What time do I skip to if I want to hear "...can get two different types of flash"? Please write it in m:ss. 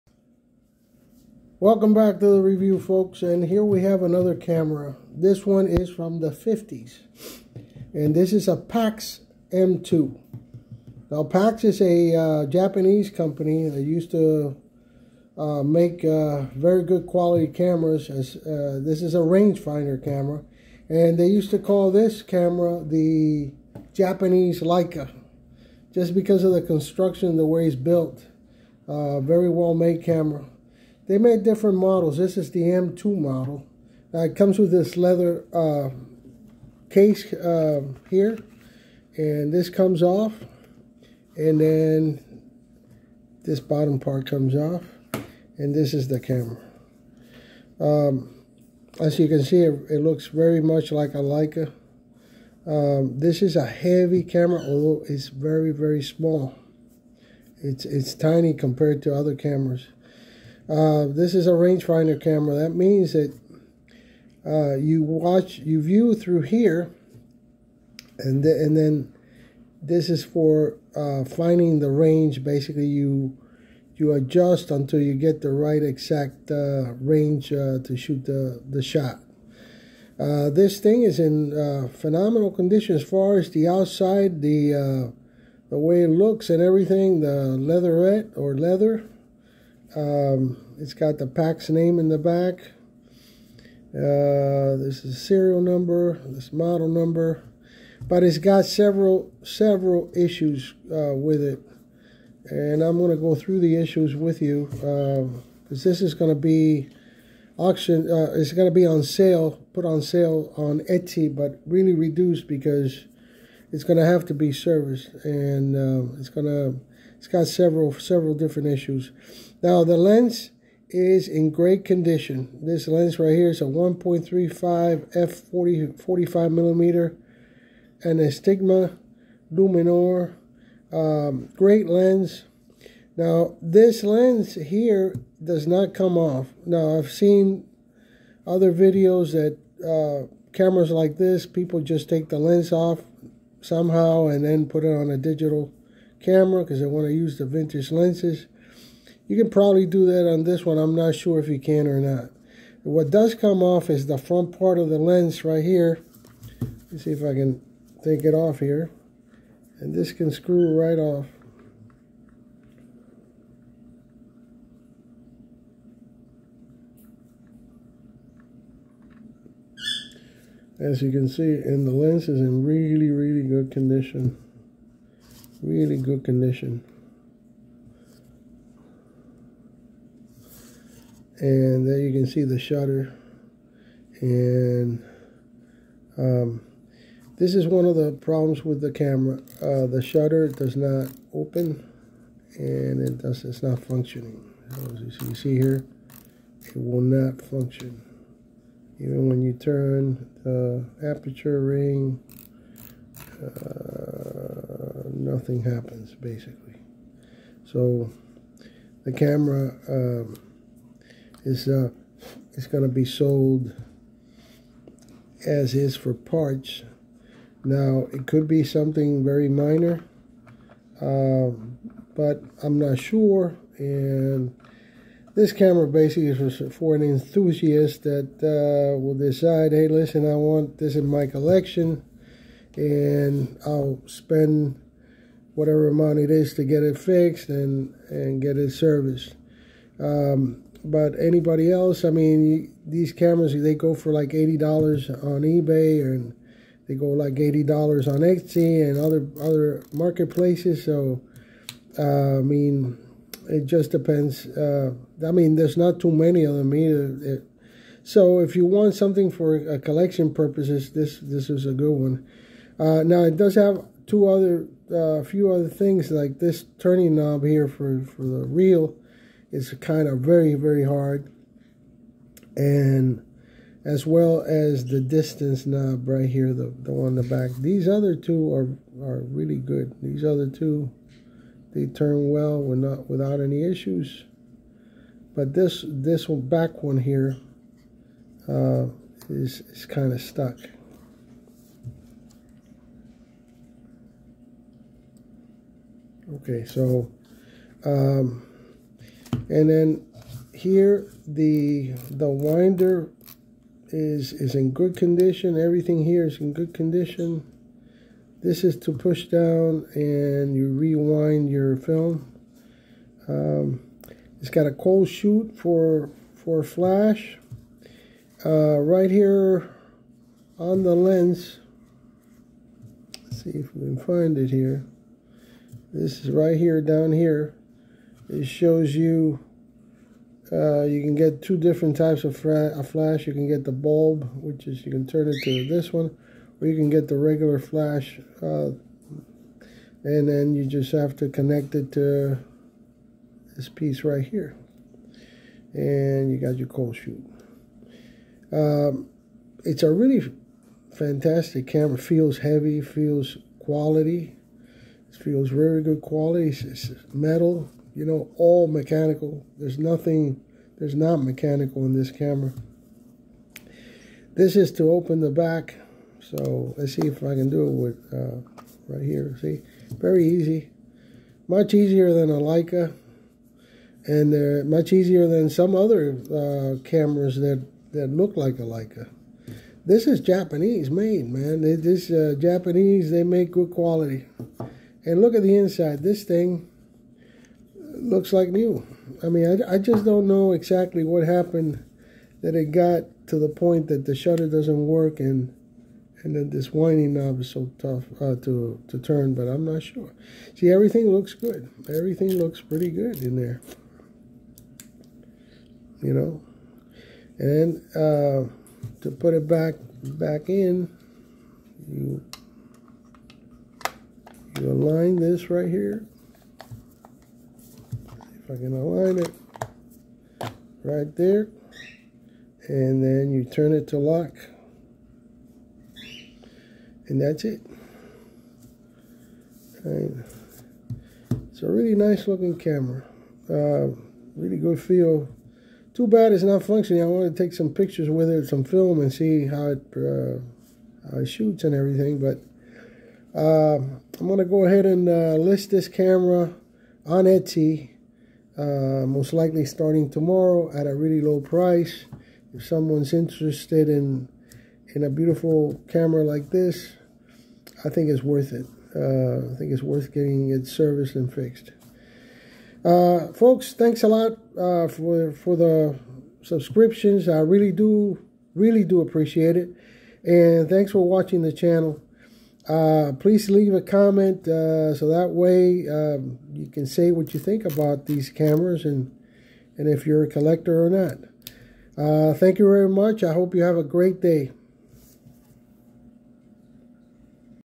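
5:31.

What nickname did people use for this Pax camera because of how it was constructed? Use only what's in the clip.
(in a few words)
the Japanese Leica.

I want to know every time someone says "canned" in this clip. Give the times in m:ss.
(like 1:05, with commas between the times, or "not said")
not said.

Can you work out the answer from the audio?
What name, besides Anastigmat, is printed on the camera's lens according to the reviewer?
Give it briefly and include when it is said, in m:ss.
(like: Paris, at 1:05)
Luminor, at 2:09.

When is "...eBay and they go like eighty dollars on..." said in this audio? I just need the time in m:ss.
4:05.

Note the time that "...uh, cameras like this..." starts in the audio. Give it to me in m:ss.
2:19.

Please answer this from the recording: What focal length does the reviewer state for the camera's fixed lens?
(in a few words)
45 millimeter.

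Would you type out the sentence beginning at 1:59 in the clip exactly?
Now the lens is in great condition.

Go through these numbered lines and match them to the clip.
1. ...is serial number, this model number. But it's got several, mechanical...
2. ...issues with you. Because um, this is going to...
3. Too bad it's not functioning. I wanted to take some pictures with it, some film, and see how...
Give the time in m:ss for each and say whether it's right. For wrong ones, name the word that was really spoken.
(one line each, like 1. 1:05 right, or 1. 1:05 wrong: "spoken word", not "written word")
1. 1:35 wrong: "several", not "mechanical"
2. 1:43 right
3. 7:15 right.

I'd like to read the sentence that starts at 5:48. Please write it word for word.
Um, it's a really fantastic camera.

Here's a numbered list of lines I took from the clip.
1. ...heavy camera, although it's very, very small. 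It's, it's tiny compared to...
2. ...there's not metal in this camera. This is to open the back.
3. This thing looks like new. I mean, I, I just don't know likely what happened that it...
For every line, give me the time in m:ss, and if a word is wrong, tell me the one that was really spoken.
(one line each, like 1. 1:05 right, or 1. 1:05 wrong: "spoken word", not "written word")
1. 0:53 right
2. 6:00 wrong: "mechanical", not "metal"
3. 6:26 wrong: "exactly", not "likely".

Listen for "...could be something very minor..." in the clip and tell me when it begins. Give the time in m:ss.
3:38.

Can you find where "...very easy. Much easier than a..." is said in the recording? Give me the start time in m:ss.
6:09.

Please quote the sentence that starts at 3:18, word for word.
Even when you turn the aperture ring, uh, nothing happens basically.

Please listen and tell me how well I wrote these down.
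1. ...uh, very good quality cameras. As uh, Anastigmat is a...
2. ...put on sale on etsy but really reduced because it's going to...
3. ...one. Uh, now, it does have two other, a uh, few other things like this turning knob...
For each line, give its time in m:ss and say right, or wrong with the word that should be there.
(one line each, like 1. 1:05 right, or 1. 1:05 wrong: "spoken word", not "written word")
1. 0:16 wrong: "This", not "Anastigmat"
2. 1:49 right
3. 4:21 right.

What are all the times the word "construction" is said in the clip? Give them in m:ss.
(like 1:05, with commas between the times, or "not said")
0:26.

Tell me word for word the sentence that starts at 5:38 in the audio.
Uh, and then you just have to connect it to this piece right here.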